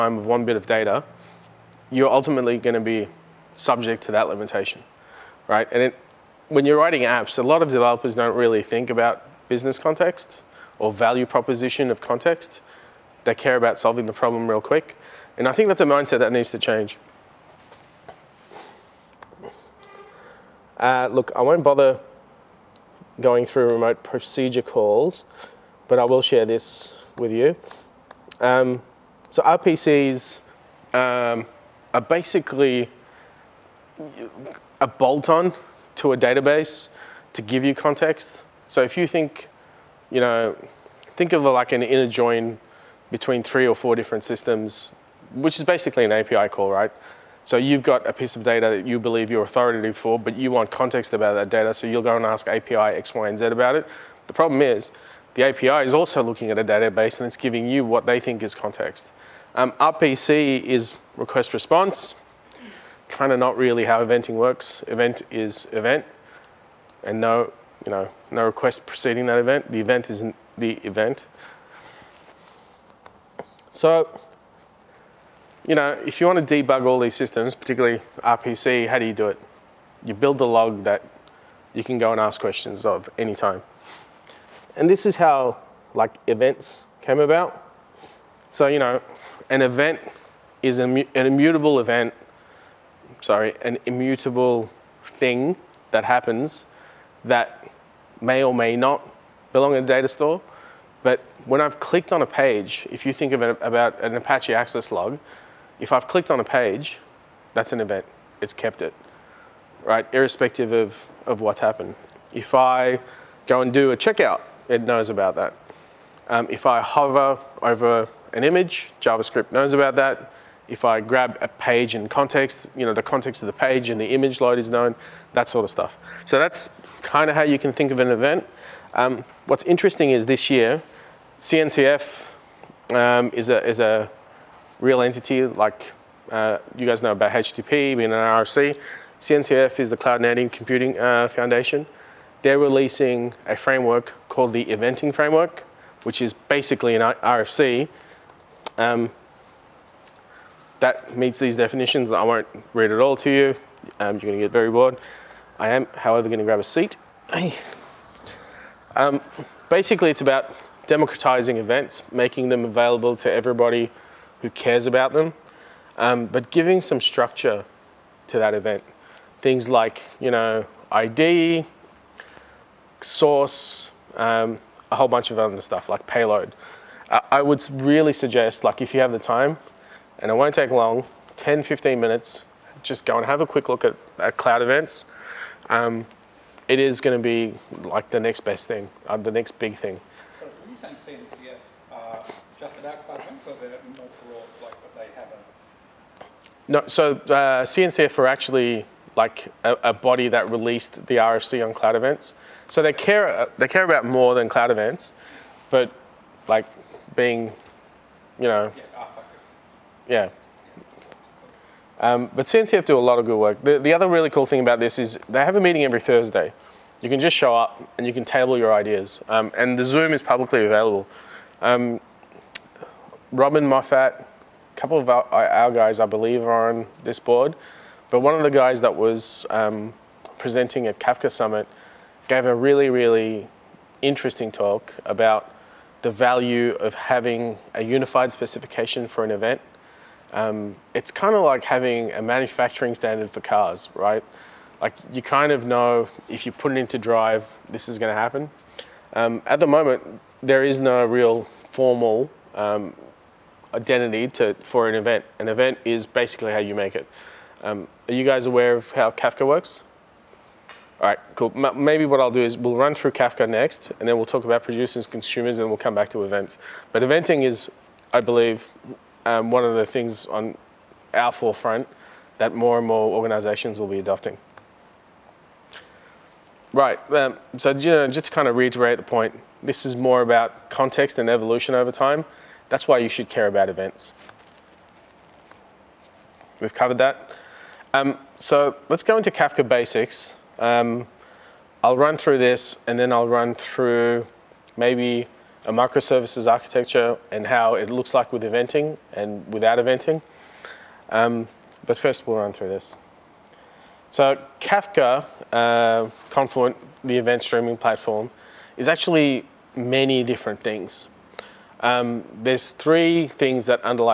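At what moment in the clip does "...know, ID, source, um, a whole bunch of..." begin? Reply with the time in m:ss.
2:50.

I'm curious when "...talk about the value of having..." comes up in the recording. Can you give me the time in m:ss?
3:54.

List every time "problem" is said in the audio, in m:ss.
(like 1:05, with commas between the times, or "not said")
0:14, 0:54.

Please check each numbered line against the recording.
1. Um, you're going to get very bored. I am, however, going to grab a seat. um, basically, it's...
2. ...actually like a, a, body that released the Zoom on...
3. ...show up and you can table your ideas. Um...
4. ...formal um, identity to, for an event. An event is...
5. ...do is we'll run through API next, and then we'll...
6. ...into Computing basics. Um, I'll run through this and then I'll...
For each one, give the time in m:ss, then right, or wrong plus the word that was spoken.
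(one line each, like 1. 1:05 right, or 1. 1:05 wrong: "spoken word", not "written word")
1. 2:33 right
2. 3:18 wrong: "RFC", not "Zoom"
3. 3:37 right
4. 4:11 right
5. 4:22 wrong: "Kafka", not "API"
6. 4:49 wrong: "Kafka", not "Computing".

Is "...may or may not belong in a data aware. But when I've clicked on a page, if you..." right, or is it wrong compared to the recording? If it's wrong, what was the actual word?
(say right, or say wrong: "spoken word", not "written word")
wrong: "store", not "aware".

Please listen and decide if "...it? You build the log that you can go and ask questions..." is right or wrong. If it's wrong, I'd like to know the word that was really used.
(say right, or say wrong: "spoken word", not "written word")
right.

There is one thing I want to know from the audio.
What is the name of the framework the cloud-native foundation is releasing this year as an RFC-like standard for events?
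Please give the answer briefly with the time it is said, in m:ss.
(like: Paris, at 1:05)
Eventing Framework, at 2:24.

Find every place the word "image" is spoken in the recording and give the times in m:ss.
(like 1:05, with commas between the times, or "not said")
1:58, 2:04.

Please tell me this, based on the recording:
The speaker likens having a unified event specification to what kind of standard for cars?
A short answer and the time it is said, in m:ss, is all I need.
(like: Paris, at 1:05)
manufacturing standard, at 4:02.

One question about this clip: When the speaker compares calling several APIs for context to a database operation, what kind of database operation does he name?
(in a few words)
inner join.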